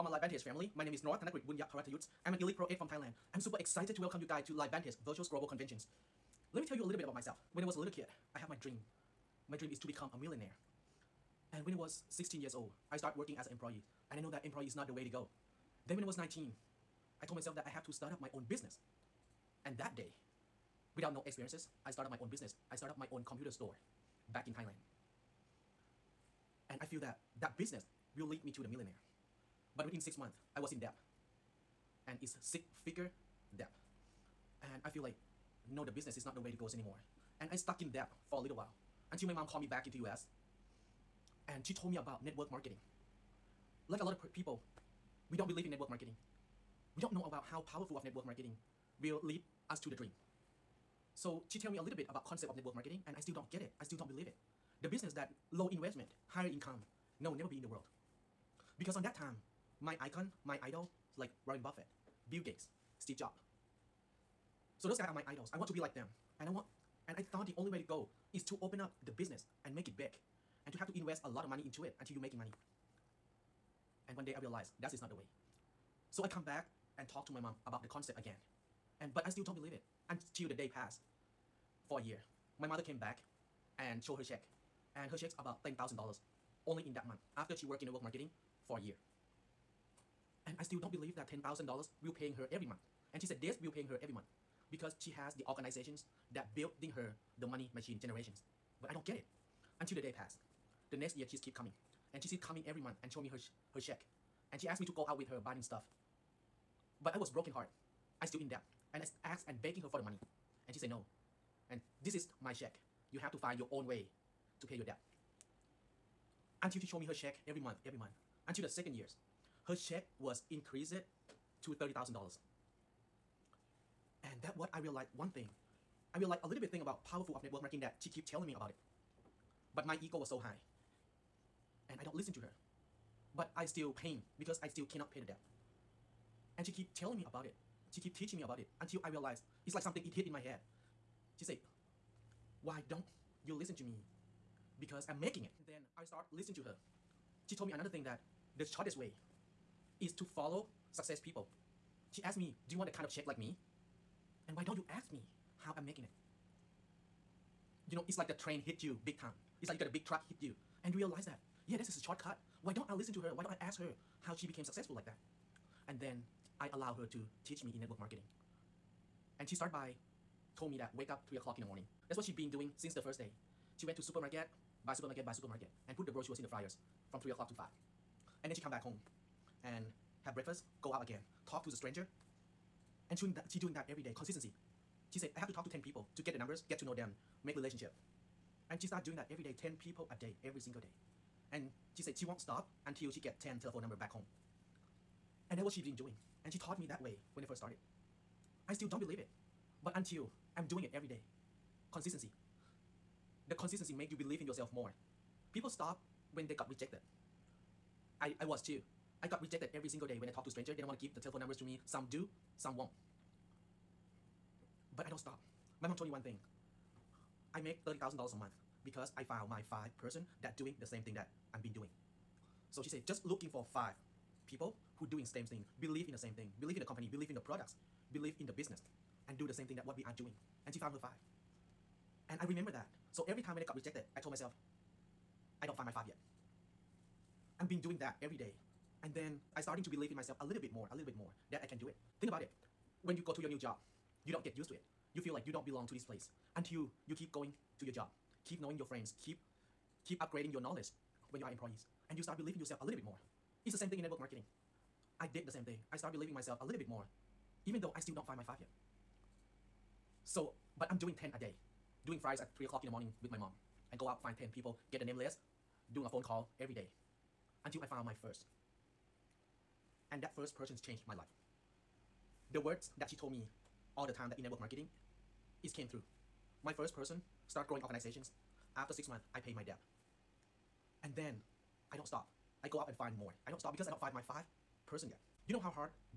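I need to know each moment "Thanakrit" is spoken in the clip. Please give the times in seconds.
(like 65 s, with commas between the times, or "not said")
1 s.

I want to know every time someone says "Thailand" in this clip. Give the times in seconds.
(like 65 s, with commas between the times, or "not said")
2 s, 24 s.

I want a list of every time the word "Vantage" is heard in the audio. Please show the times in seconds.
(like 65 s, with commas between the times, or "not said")
0 s, 4 s.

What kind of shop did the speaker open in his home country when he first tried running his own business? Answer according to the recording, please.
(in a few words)
Computer store.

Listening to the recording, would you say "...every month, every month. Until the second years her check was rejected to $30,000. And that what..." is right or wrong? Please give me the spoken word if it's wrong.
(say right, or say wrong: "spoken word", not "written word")
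wrong: "increased", not "rejected".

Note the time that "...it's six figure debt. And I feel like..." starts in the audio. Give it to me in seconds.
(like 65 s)
32 s.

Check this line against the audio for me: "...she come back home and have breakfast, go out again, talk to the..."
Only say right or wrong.
right.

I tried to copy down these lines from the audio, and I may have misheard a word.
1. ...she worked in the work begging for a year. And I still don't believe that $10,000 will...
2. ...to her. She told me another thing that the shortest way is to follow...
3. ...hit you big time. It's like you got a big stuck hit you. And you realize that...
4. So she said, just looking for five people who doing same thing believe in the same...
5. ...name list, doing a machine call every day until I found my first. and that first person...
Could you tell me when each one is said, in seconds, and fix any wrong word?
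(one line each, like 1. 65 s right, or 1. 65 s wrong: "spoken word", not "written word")
1. 87 s wrong: "marketing", not "begging"
2. 146 s right
3. 158 s wrong: "truck", not "stuck"
4. 222 s right
5. 265 s wrong: "phone", not "machine".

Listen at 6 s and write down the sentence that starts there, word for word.
Let me tell you a little bit about myself.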